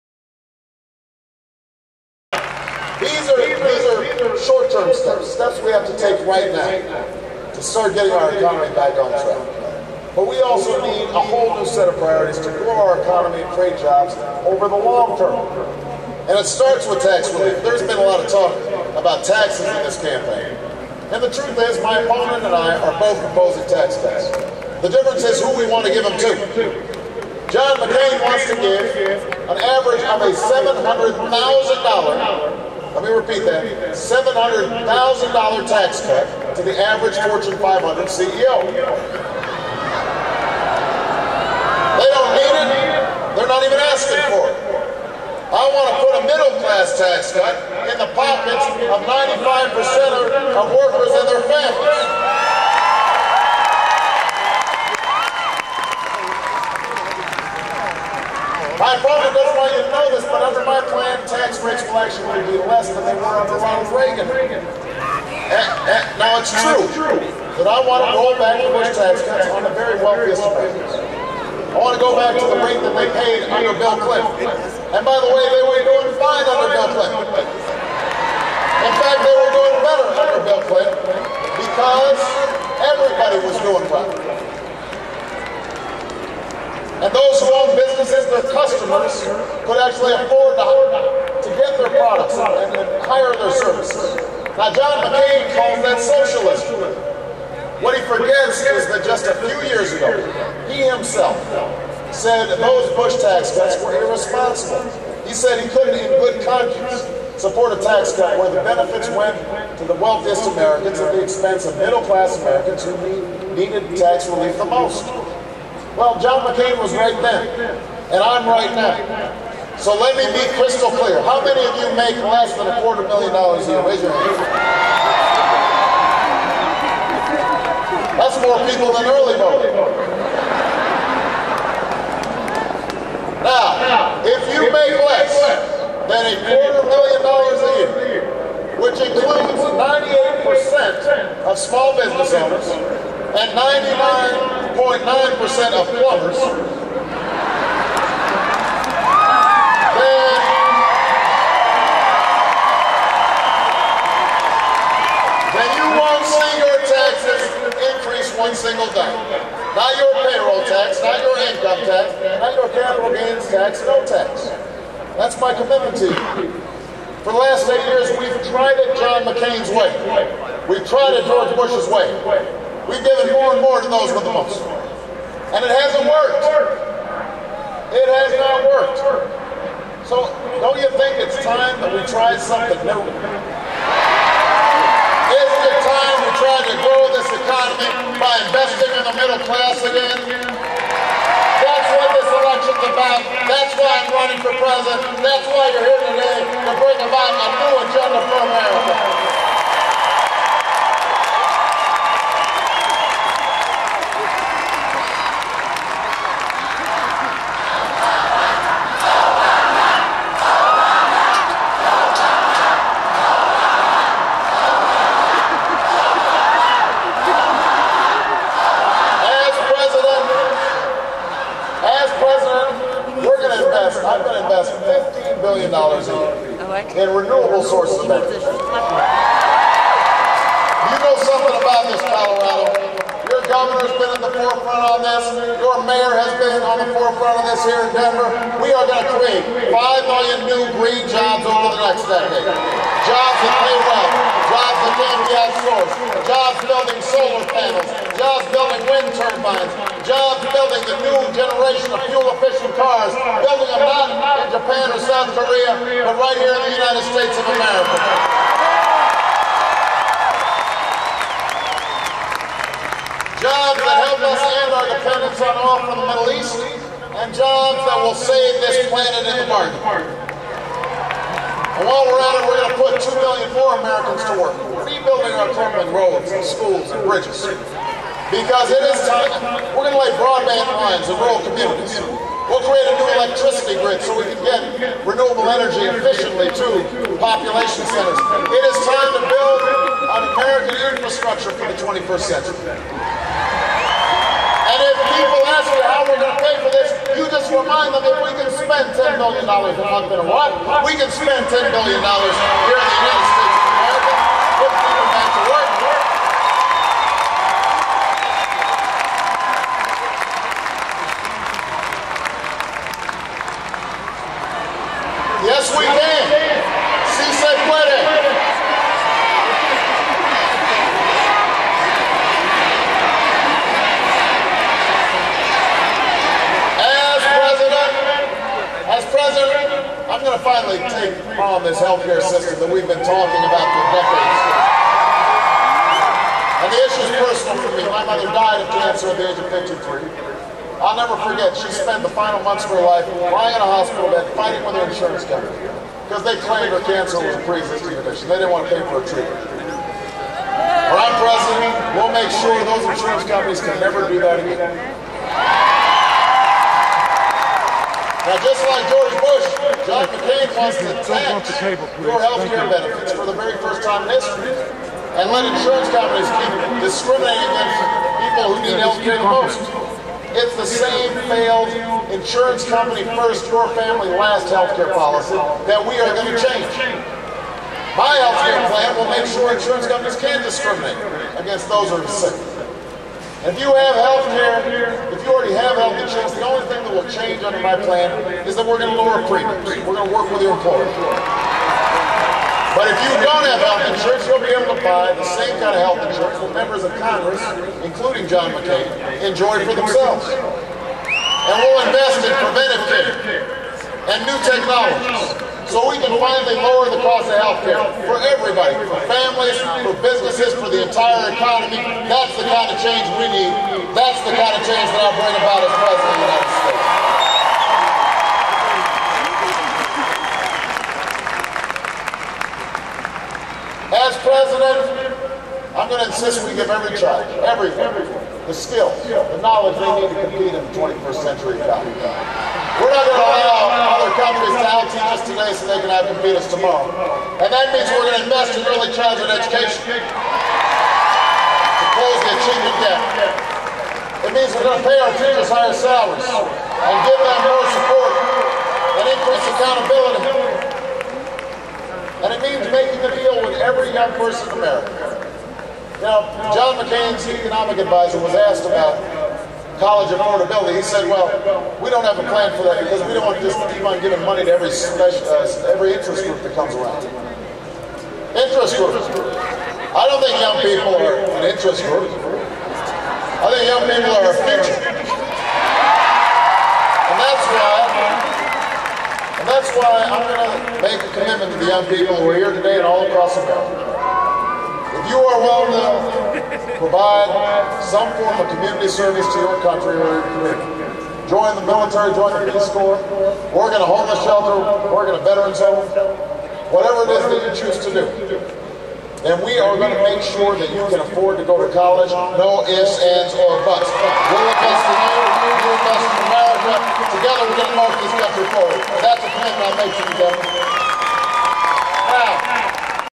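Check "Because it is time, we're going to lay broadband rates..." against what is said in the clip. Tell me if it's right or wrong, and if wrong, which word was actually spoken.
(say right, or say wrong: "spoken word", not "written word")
wrong: "lines", not "rates".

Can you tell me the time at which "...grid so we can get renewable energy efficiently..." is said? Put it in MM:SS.
04:43.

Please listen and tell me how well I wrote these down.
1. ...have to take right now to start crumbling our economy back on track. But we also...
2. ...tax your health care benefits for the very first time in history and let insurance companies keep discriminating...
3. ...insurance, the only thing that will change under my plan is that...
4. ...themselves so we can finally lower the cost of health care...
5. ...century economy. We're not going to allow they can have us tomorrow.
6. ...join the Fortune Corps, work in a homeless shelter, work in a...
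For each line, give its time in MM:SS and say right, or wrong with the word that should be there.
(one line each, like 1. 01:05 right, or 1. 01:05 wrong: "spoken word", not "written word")
1. 00:05 wrong: "getting", not "crumbling"
2. 06:01 right
3. 06:25 right
4. 06:44 wrong: "technologies", not "themselves"
5. 07:11 right
6. 08:12 wrong: "Peace", not "Fortune".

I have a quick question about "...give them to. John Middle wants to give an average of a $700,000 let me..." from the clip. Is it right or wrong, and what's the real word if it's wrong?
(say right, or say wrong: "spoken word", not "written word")
wrong: "McCain", not "Middle".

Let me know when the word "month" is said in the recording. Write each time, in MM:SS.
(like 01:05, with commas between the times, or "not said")
04:59, 05:42.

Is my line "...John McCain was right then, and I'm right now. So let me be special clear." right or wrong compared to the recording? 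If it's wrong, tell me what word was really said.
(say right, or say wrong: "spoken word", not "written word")
wrong: "crystal", not "special".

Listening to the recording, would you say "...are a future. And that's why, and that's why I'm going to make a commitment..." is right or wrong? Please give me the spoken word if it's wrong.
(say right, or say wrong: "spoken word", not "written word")
right.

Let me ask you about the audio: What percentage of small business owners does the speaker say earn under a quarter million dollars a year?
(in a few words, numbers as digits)
98%.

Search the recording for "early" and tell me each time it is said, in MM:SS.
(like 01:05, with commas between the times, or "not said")
02:09, 07:18.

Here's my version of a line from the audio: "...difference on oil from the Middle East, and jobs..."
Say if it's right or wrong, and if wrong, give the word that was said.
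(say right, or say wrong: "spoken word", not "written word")
wrong: "dependence", not "difference".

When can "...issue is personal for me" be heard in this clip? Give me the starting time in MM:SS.
05:36.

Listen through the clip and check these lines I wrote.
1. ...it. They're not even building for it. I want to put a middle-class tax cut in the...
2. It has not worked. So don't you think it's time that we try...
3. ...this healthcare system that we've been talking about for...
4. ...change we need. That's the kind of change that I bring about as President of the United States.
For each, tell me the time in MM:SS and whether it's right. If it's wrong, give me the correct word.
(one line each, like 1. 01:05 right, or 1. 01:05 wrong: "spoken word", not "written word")
1. 00:42 wrong: "asking", not "building"
2. 02:57 right
3. 05:31 right
4. 06:52 right.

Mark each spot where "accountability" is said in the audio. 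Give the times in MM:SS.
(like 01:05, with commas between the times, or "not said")
07:29.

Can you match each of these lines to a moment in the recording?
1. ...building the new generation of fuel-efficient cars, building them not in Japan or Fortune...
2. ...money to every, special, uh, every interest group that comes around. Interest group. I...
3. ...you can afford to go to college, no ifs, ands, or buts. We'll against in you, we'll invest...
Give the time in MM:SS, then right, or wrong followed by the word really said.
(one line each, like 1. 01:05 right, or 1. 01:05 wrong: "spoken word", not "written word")
1. 04:10 wrong: "South", not "Fortune"
2. 07:44 right
3. 08:20 wrong: "invest", not "against".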